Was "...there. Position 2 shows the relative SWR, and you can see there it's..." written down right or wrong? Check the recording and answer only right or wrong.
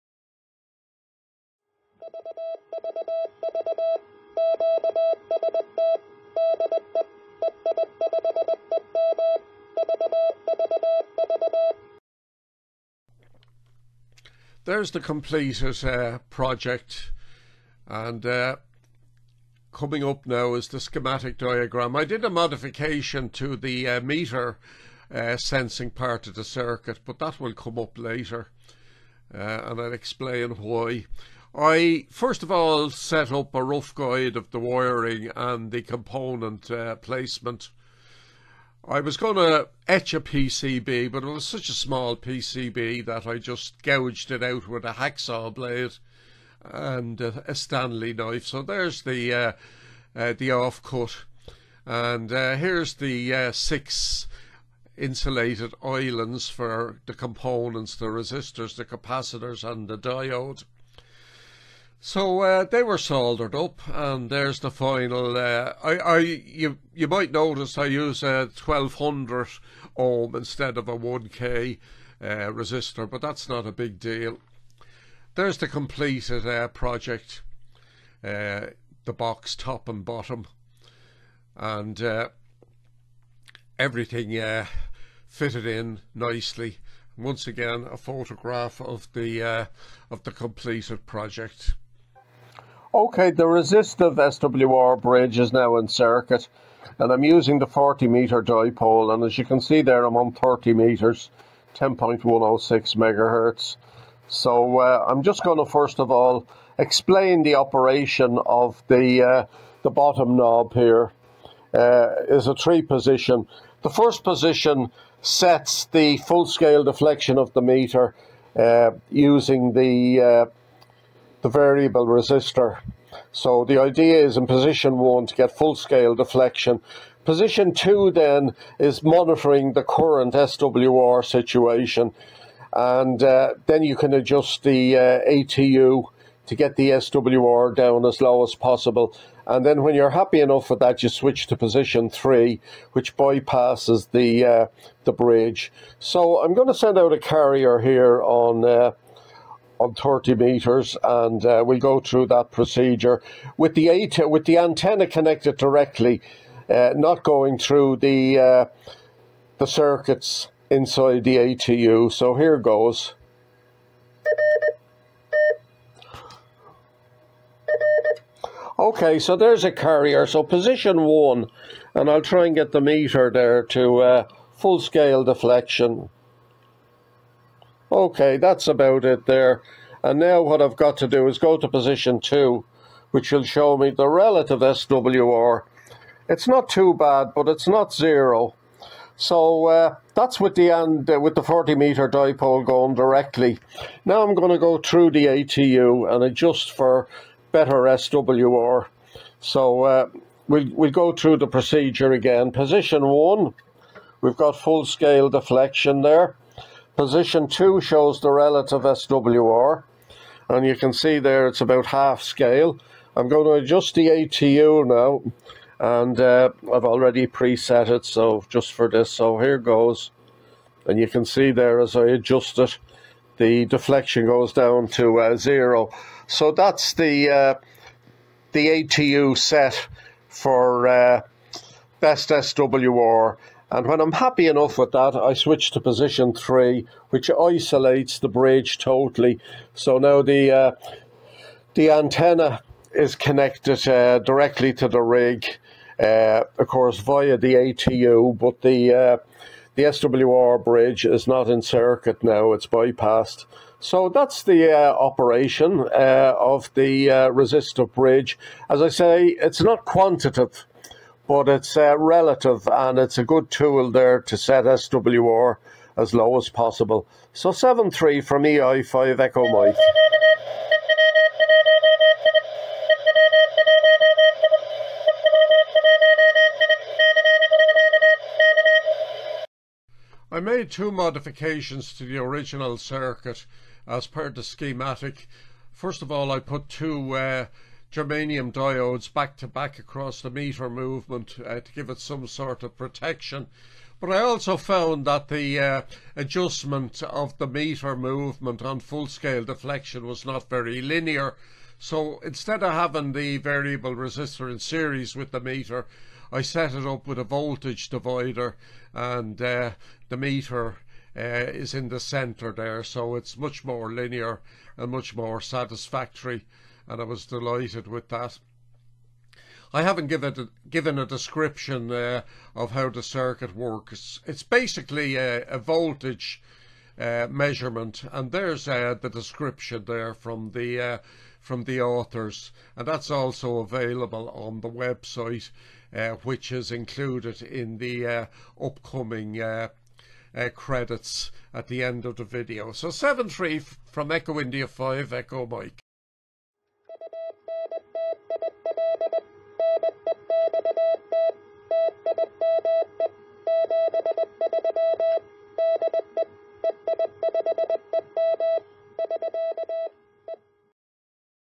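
right.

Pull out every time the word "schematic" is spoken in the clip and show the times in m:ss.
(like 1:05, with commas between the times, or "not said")
0:20, 4:44.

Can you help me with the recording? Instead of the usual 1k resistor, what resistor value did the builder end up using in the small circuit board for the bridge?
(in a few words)
1200 ohm.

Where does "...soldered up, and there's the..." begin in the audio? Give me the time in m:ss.
1:02.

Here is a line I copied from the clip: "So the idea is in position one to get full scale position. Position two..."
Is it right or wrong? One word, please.
wrong.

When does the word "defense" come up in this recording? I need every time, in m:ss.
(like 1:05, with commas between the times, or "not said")
not said.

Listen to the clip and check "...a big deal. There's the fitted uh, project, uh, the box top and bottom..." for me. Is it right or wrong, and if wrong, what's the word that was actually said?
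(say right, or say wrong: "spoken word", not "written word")
wrong: "completed", not "fitted".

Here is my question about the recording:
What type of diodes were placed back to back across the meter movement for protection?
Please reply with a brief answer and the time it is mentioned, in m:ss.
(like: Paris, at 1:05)
germanium, at 4:47.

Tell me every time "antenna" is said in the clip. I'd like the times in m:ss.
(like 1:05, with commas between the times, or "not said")
2:34, 4:01.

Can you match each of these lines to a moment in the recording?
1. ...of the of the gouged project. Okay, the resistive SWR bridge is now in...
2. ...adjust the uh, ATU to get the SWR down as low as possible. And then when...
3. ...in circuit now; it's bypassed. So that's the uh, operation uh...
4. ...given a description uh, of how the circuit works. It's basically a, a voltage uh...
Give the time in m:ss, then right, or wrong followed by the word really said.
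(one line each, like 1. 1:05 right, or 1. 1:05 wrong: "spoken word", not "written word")
1. 1:28 wrong: "completed", not "gouged"
2. 2:14 right
3. 4:11 right
4. 5:20 right.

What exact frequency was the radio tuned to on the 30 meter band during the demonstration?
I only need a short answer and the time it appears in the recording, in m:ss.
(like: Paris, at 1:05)
10.106 MHz, at 1:41.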